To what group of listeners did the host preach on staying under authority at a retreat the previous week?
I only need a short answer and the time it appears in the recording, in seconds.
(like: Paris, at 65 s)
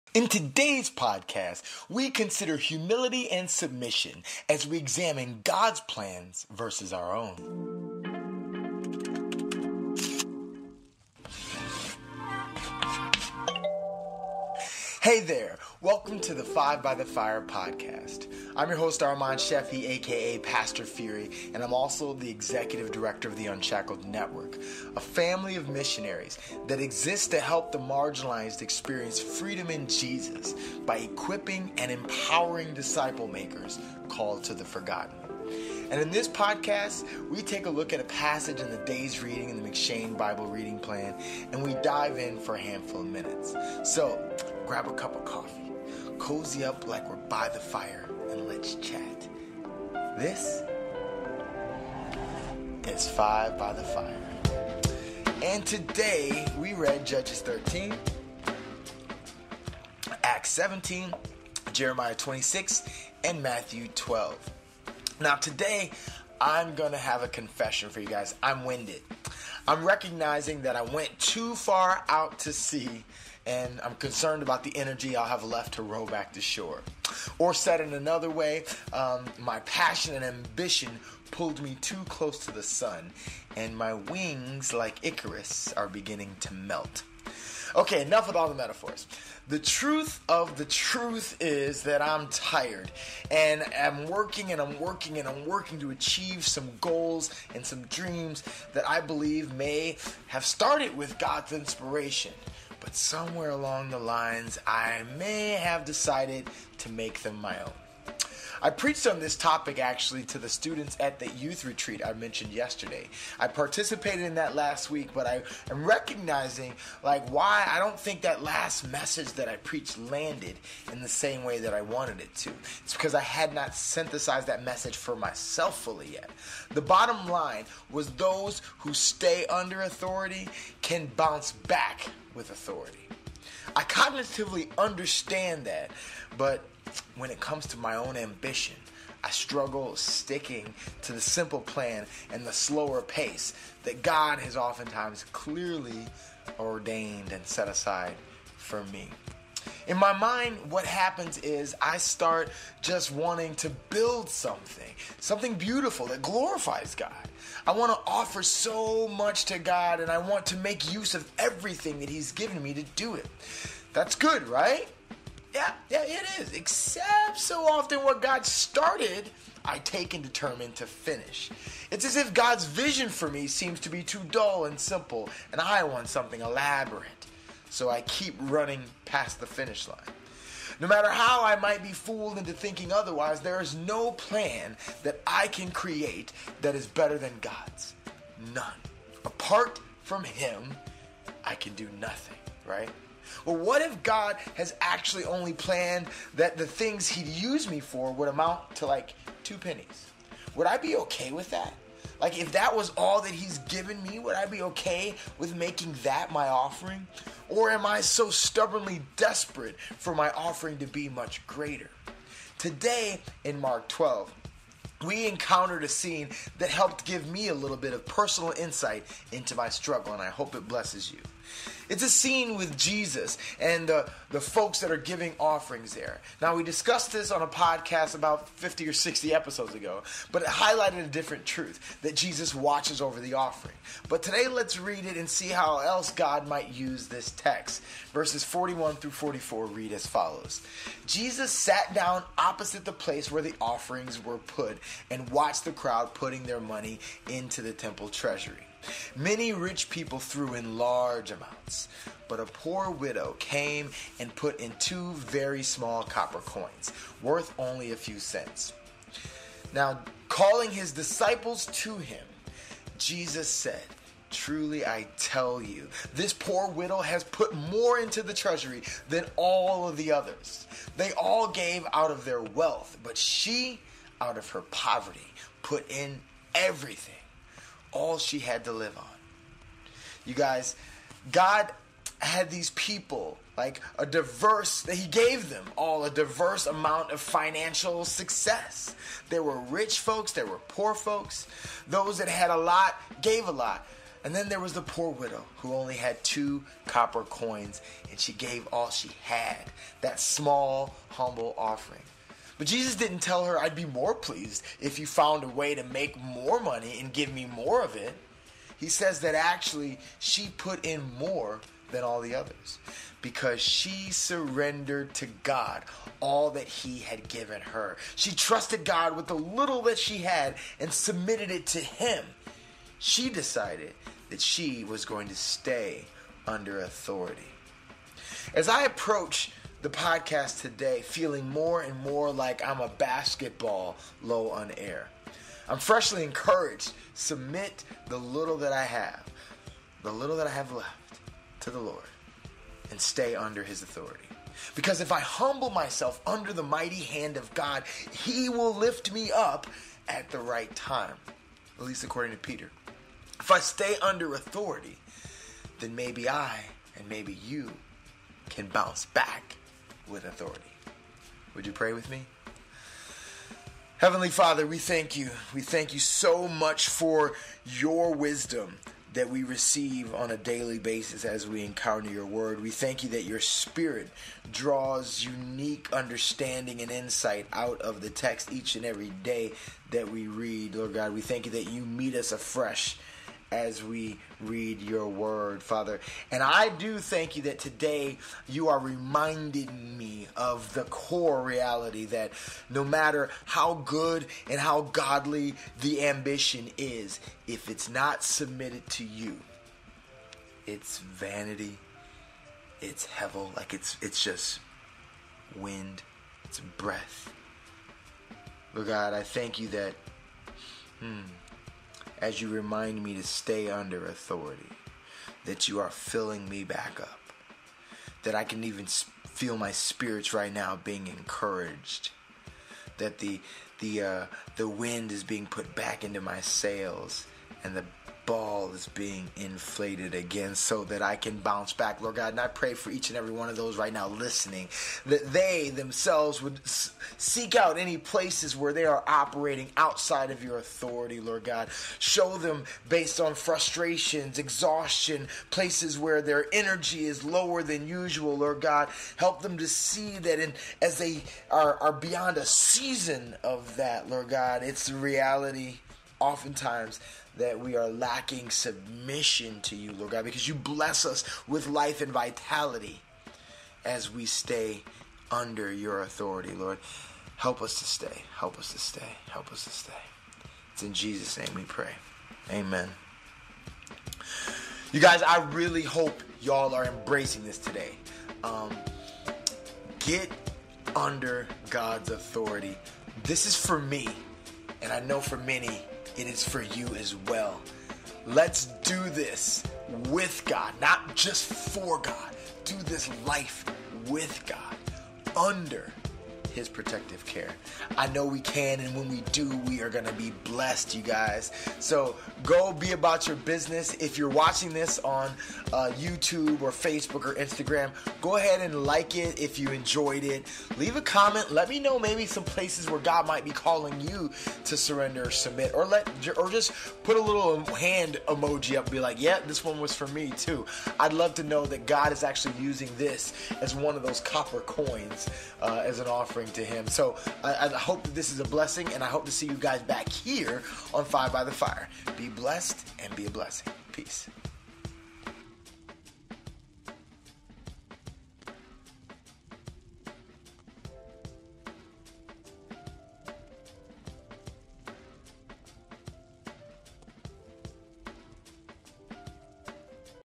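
students, at 110 s.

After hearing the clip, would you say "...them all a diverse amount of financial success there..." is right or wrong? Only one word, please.
right.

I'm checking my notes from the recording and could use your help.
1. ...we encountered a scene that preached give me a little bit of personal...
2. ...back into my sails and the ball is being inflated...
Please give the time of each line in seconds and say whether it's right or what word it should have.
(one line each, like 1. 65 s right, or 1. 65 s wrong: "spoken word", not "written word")
1. 215 s wrong: "helped", not "preached"
2. 425 s right.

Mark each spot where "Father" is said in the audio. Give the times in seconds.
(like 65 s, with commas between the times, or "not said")
364 s, 385 s.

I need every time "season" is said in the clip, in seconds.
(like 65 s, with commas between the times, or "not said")
452 s.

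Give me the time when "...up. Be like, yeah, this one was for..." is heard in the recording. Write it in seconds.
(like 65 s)
518 s.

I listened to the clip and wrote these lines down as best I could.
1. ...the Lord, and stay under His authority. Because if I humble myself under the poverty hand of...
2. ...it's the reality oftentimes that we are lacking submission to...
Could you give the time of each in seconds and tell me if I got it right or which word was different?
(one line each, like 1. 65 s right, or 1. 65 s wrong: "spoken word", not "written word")
1. 341 s wrong: "mighty", not "poverty"
2. 454 s right.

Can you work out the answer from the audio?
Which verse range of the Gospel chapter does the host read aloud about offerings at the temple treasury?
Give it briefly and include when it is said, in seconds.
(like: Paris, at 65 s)
41 through 44, at 238 s.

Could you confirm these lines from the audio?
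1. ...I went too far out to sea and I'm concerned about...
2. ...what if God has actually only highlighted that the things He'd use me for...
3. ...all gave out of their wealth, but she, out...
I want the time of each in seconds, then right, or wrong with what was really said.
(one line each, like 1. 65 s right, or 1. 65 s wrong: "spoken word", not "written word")
1. 70 s right
2. 193 s wrong: "planned", not "highlighted"
3. 271 s right.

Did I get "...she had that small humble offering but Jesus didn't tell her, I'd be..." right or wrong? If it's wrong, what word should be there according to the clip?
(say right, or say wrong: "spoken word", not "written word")
right.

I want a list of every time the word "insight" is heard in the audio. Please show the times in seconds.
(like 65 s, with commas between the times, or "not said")
218 s, 376 s.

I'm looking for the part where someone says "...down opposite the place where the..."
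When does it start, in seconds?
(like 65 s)
241 s.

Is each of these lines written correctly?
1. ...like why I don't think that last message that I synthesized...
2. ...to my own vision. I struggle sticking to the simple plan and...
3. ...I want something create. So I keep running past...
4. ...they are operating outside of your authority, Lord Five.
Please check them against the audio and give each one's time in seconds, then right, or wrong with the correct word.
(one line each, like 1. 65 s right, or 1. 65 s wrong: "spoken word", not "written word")
1. 117 s wrong: "preached", not "synthesized"
2. 137 s wrong: "ambition", not "vision"
3. 175 s wrong: "elaborate", not "create"
4. 438 s wrong: "God", not "Five".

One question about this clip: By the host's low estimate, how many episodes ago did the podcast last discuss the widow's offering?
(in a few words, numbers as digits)
50.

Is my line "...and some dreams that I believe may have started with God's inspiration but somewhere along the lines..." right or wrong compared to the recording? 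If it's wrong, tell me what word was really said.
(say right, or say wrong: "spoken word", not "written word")
right.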